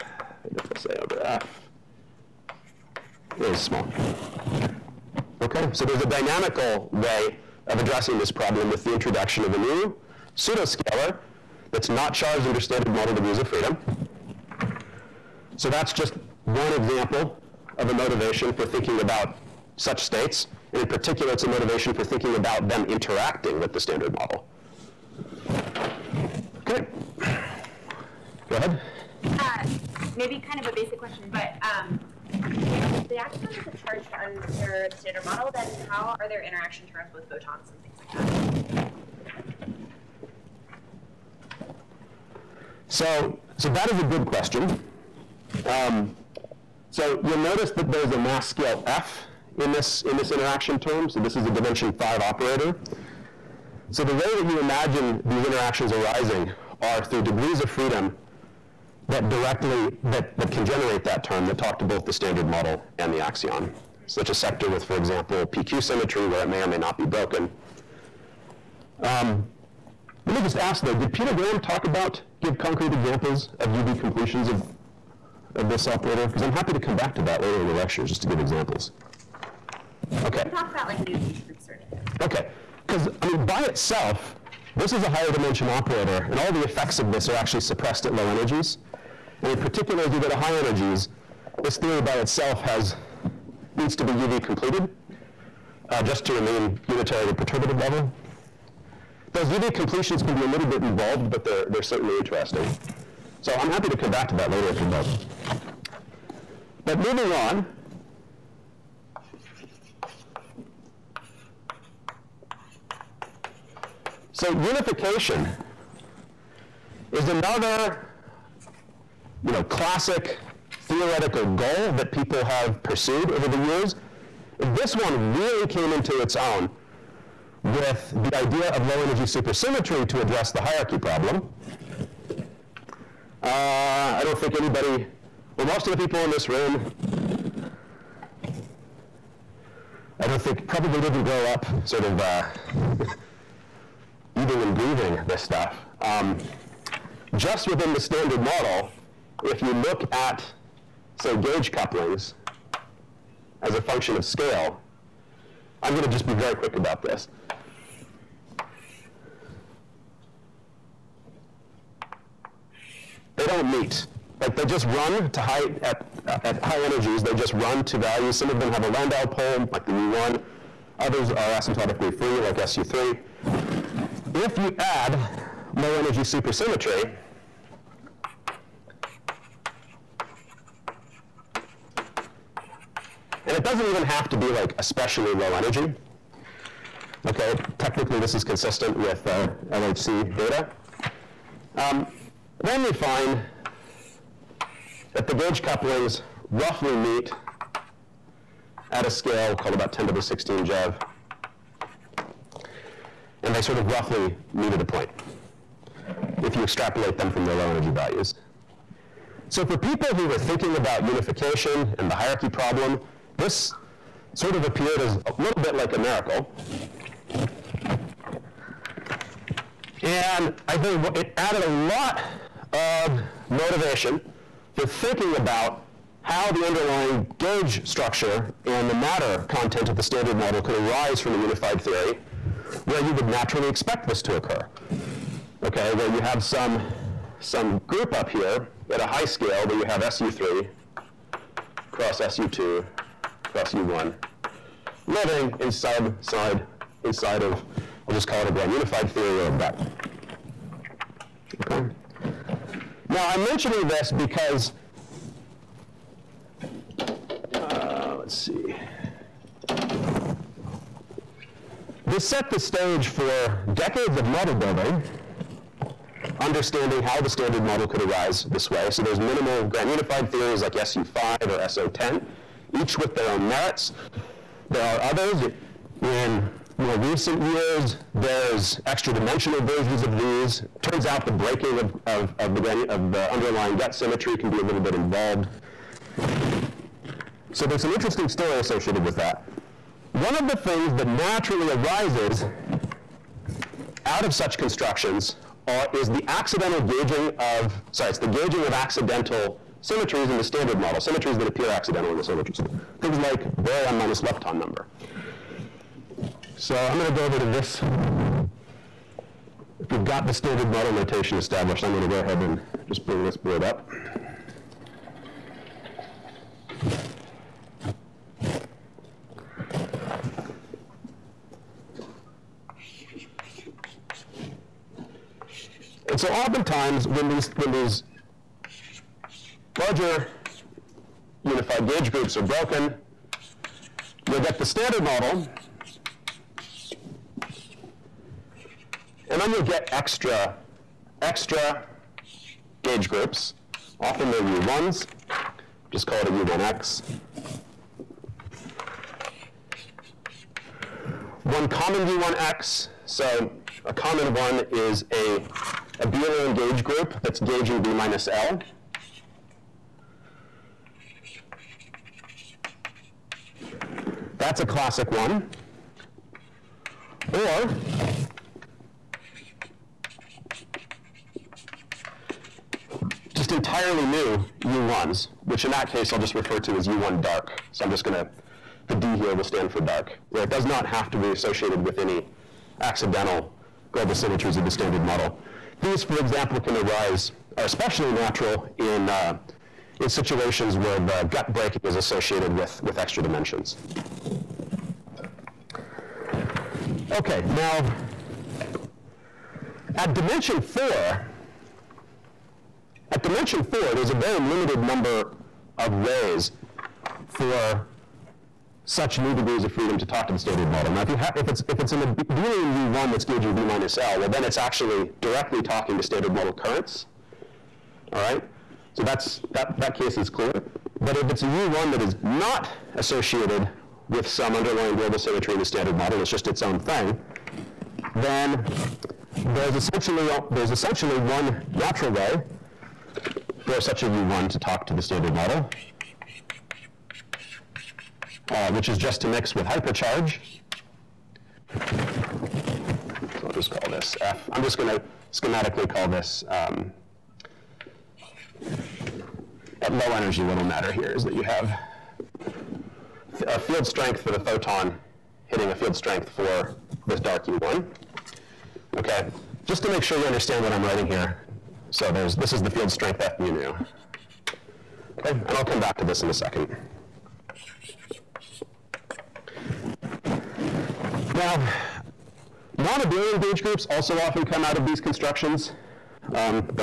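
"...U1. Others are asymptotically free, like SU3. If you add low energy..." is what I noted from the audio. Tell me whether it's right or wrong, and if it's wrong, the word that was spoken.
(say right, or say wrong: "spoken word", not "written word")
right.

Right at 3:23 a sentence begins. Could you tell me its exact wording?
And they sort of roughly meet at a point if you extrapolate them from their low energy values.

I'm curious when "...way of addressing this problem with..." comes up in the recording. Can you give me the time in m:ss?
0:06.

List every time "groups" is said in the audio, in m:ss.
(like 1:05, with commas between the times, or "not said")
3:57, 5:32, 5:43, 5:56, 7:53.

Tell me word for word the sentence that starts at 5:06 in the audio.
So I'm going to go over to this.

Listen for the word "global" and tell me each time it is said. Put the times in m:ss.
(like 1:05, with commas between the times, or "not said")
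6:23, 7:04.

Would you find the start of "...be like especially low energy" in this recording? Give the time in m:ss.
3:04.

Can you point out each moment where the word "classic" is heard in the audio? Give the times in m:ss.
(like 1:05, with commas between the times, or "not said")
1:59, 6:04.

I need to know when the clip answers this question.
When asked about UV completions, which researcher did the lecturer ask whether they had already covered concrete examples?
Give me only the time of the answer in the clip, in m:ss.
1:11.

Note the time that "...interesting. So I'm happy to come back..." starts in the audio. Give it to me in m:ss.
1:42.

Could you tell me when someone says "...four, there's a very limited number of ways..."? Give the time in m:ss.
6:43.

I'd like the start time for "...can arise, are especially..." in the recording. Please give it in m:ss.
6:26.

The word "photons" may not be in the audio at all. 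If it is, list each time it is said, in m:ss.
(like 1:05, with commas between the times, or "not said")
0:37, 7:34.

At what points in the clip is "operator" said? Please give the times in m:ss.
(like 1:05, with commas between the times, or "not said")
0:52, 1:15, 1:25.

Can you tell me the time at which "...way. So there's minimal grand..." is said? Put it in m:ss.
4:28.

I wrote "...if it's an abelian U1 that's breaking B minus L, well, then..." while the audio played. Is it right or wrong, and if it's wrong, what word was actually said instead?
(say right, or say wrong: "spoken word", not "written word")
wrong: "gauging", not "breaking".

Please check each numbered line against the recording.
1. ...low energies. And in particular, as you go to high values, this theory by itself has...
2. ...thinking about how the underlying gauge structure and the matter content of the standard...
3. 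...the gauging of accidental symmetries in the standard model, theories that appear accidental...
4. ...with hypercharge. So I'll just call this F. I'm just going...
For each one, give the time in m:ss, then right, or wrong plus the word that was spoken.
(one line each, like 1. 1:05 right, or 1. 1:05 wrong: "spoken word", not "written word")
1. 1:28 wrong: "energies", not "values"
2. 3:44 right
3. 4:58 wrong: "symmetries", not "theories"
4. 7:19 right.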